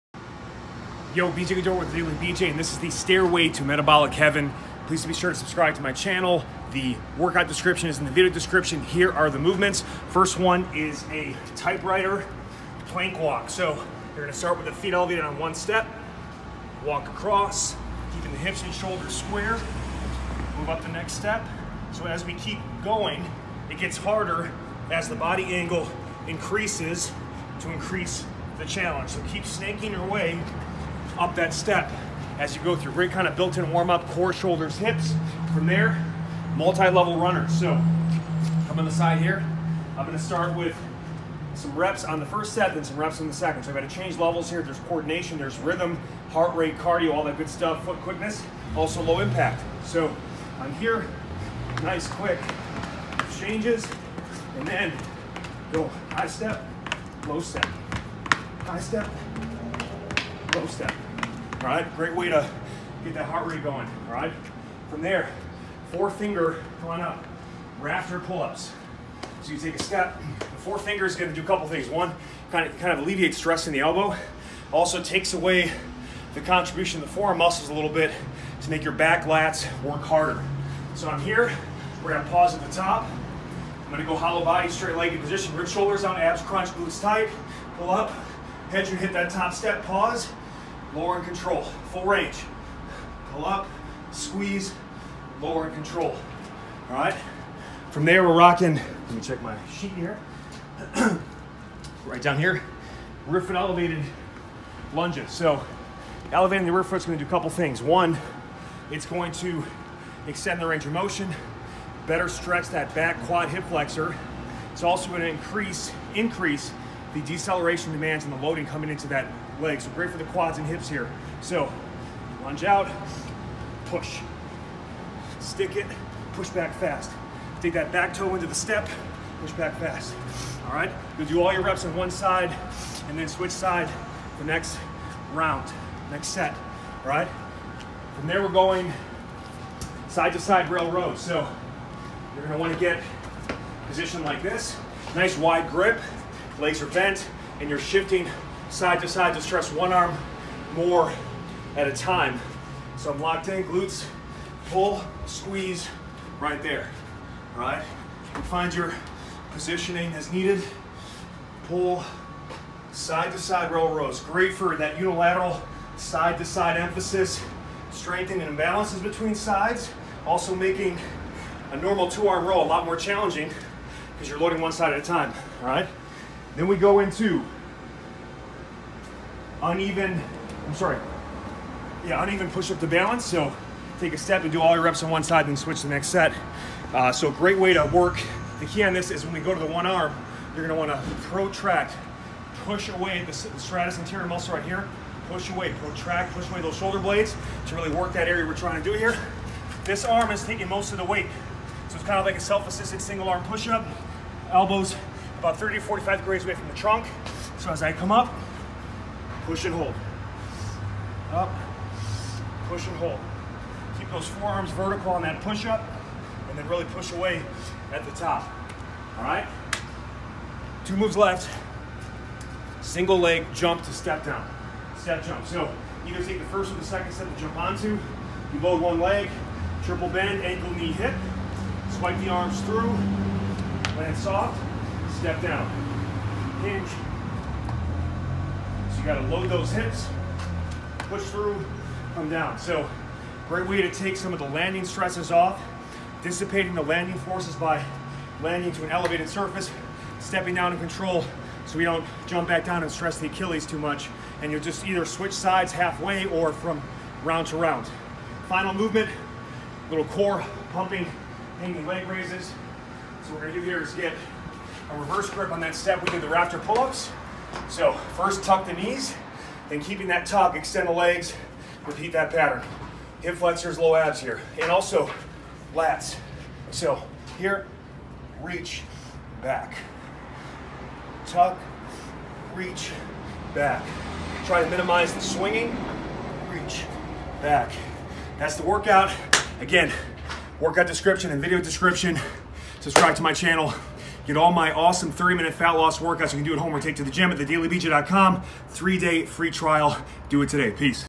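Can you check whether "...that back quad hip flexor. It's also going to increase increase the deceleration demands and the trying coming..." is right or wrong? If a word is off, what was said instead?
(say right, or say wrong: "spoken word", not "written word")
wrong: "loading", not "trying".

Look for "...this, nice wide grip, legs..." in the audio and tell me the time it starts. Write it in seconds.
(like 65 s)
144 s.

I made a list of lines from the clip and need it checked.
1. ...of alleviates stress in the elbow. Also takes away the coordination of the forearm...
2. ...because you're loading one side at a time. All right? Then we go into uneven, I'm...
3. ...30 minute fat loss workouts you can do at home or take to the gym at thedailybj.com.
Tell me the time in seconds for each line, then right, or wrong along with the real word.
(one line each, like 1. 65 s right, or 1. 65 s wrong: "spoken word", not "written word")
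1. 72 s wrong: "contribution", not "coordination"
2. 174 s right
3. 295 s right.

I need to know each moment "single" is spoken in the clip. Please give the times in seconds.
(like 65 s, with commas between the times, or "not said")
203 s, 222 s.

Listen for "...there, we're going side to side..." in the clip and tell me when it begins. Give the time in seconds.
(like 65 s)
138 s.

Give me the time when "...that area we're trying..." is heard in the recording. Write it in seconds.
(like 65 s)
198 s.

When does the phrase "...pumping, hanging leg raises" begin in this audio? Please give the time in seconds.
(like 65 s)
260 s.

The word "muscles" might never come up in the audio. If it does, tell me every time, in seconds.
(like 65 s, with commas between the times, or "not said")
77 s, 194 s.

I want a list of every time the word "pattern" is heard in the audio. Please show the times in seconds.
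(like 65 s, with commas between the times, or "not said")
272 s.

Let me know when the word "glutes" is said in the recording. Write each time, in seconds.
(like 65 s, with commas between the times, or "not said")
86 s, 153 s.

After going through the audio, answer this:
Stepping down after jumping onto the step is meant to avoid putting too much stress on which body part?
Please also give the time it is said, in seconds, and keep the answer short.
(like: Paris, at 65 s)
Achilles, at 253 s.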